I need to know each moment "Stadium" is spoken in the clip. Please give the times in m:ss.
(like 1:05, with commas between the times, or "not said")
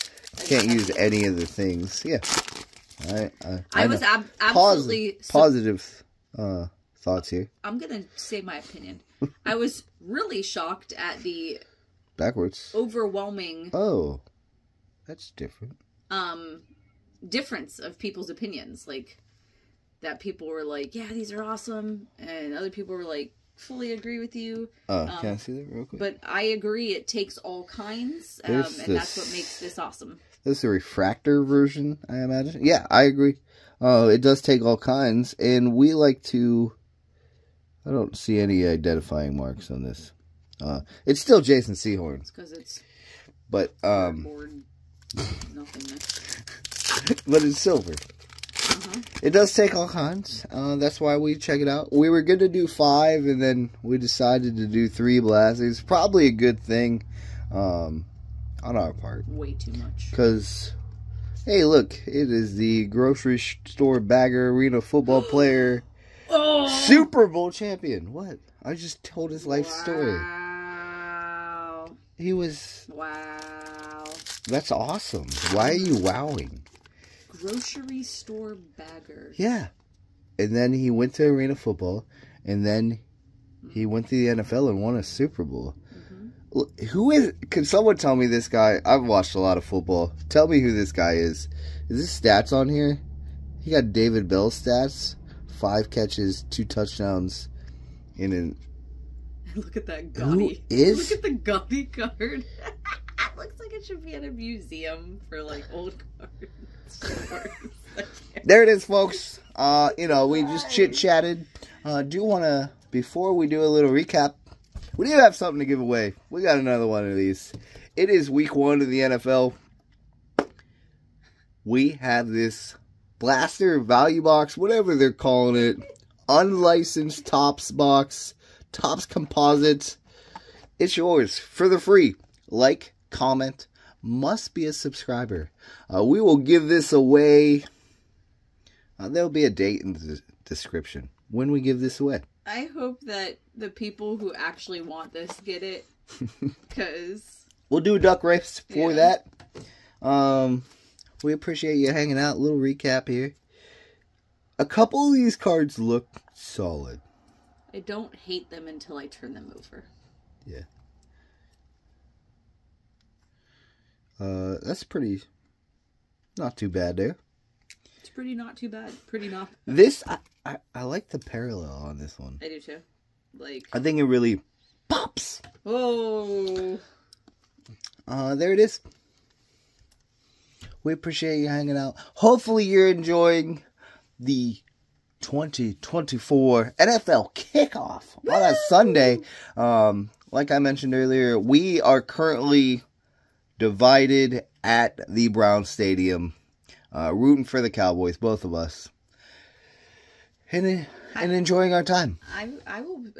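3:15.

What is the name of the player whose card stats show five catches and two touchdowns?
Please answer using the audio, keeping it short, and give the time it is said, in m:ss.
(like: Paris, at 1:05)
David Bell, at 1:33.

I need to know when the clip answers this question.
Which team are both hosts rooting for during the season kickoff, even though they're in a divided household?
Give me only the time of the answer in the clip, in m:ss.
3:17.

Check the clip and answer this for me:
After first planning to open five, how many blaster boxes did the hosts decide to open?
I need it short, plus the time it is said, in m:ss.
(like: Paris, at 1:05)
3, at 0:54.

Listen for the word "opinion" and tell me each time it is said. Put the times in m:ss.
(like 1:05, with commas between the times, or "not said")
0:08, 0:18.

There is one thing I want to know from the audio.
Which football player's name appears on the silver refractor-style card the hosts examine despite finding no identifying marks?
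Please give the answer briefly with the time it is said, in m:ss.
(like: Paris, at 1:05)
Jason Sehorn, at 0:41.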